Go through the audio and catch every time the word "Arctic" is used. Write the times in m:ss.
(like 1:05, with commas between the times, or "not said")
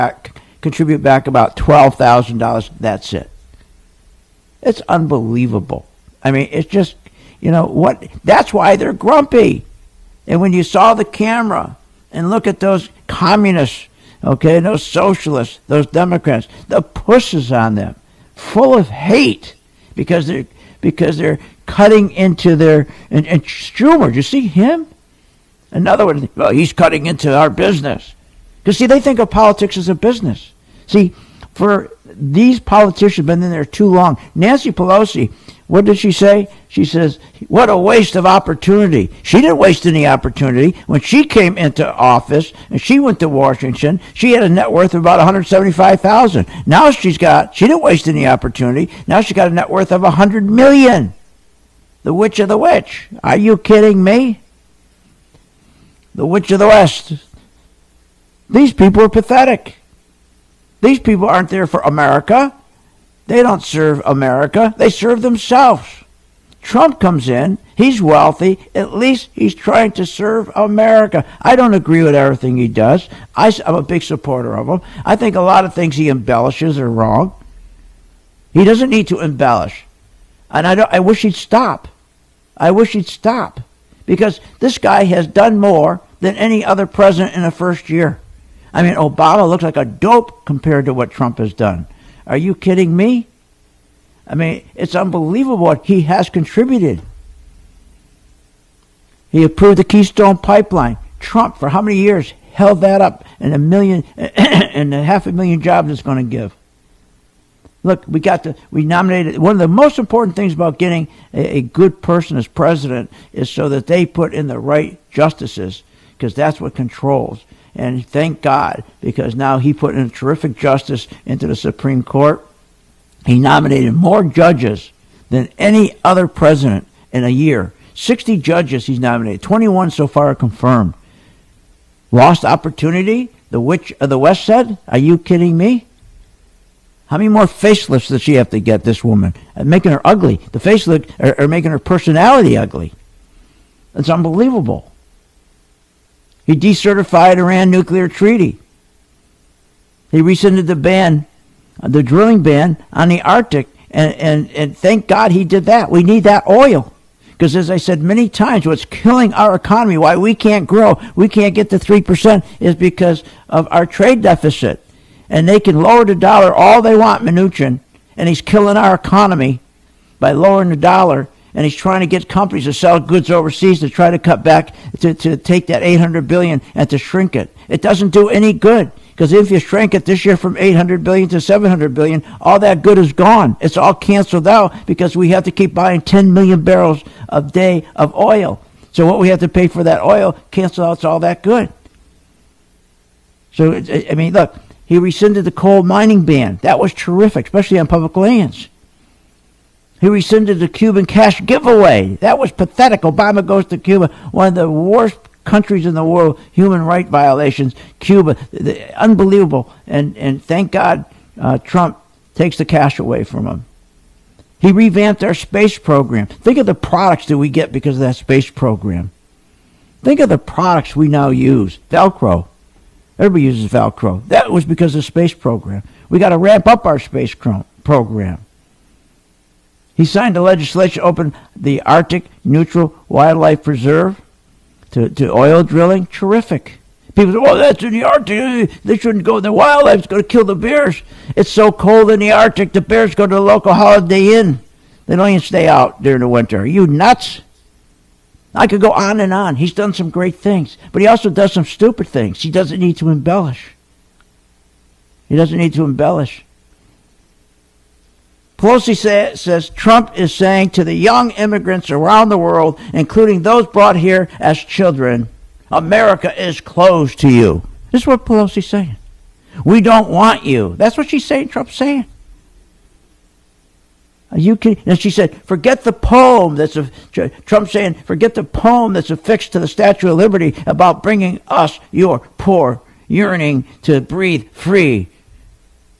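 2:33, 3:51, 3:58, 4:02.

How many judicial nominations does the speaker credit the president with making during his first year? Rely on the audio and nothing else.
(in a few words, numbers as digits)
60.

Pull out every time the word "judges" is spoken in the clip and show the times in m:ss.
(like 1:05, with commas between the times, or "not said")
2:04, 2:08.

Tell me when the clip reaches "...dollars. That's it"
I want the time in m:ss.
0:02.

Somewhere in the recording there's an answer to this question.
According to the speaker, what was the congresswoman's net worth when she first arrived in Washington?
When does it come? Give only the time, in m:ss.
0:45.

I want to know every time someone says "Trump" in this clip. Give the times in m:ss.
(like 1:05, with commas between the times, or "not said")
1:06, 1:31, 1:41, 3:31, 4:19, 4:31, 4:37.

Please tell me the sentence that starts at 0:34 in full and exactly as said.
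Nancy Pelosi, what did she say?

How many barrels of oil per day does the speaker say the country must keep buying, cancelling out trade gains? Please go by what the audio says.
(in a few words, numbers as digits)
10 million.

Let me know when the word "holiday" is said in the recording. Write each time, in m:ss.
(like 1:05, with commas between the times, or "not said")
4:03.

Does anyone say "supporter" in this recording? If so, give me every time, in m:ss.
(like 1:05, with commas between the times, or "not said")
1:14.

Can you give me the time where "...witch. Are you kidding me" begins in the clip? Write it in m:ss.
0:52.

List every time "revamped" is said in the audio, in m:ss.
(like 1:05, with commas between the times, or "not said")
3:34.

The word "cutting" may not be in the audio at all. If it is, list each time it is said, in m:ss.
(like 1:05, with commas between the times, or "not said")
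0:21, 0:26.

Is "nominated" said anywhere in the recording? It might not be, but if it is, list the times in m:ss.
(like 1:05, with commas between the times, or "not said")
1:48, 2:03, 2:08.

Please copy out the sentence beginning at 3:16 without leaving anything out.
That was terrific, especially on public lands.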